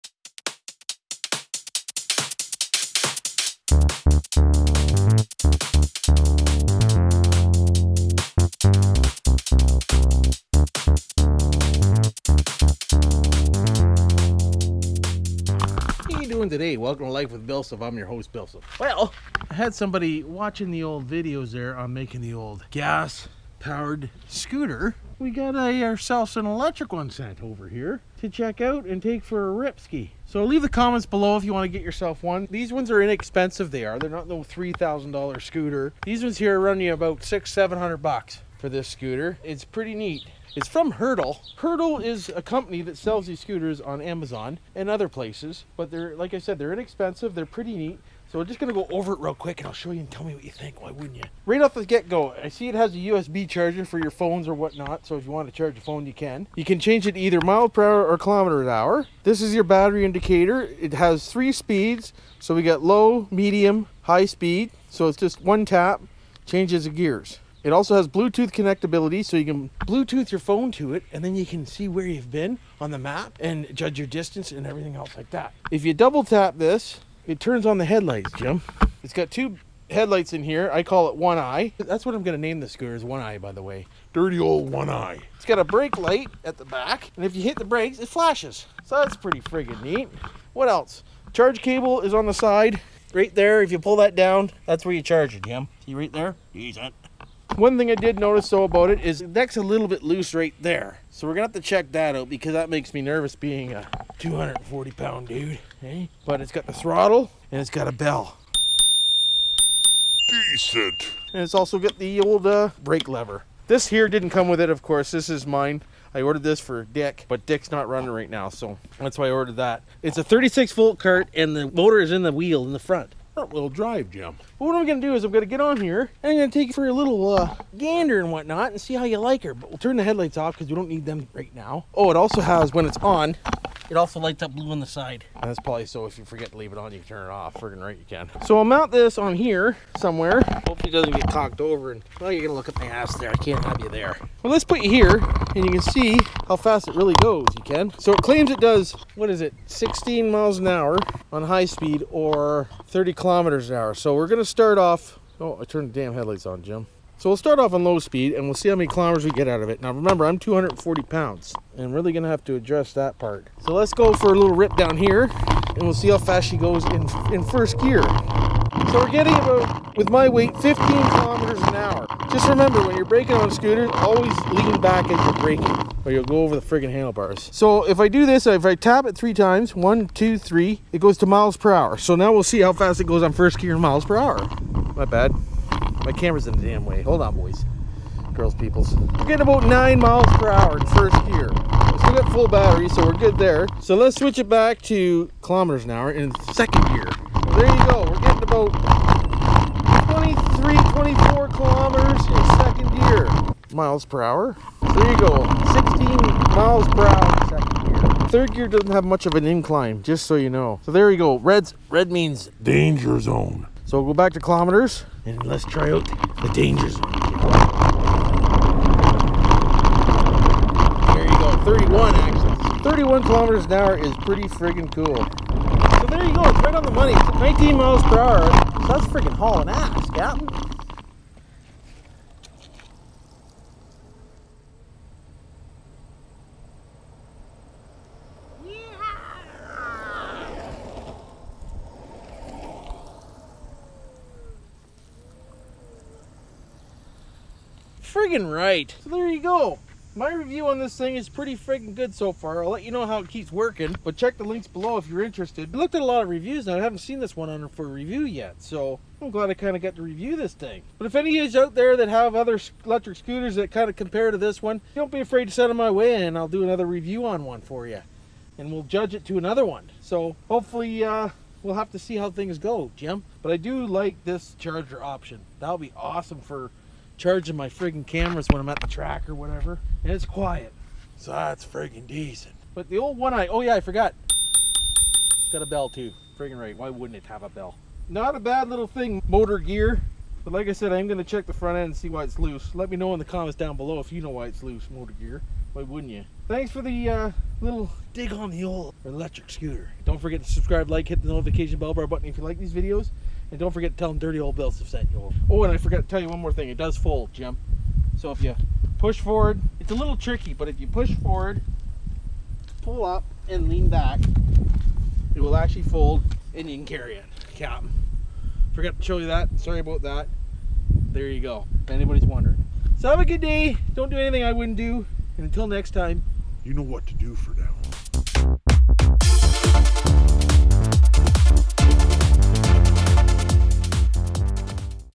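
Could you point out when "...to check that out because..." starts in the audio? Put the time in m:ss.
1:41.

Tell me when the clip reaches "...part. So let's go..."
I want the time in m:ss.
2:43.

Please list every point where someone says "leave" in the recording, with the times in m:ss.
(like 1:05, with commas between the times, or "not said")
0:30, 2:16.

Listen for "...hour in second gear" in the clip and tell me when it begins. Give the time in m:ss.
3:15.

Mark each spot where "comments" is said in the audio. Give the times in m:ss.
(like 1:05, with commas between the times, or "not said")
0:30, 4:53.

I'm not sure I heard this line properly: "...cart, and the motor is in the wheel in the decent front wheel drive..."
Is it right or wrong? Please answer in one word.
wrong.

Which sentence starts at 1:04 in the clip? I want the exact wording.
So it's just one tap, changes the gears.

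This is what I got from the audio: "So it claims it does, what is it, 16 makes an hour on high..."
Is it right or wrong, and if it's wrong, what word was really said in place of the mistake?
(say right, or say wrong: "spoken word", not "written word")
wrong: "miles", not "makes".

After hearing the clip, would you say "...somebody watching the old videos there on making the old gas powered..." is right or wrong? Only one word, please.
right.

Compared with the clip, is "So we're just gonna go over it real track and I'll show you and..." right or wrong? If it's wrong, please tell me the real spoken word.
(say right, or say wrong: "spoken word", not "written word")
wrong: "quick", not "track".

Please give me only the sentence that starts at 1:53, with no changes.
This here didn't come with it, of course.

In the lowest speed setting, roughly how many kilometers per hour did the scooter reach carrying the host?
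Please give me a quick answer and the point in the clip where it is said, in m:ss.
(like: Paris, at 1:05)
15 kilometers an hour, at 2:50.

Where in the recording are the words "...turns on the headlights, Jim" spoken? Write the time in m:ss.
1:17.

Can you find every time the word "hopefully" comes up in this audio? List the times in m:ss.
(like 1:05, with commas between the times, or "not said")
2:20, 4:30.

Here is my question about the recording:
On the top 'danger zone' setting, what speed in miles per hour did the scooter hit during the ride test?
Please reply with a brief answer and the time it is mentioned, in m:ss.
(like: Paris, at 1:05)
19 miles per hour, at 3:47.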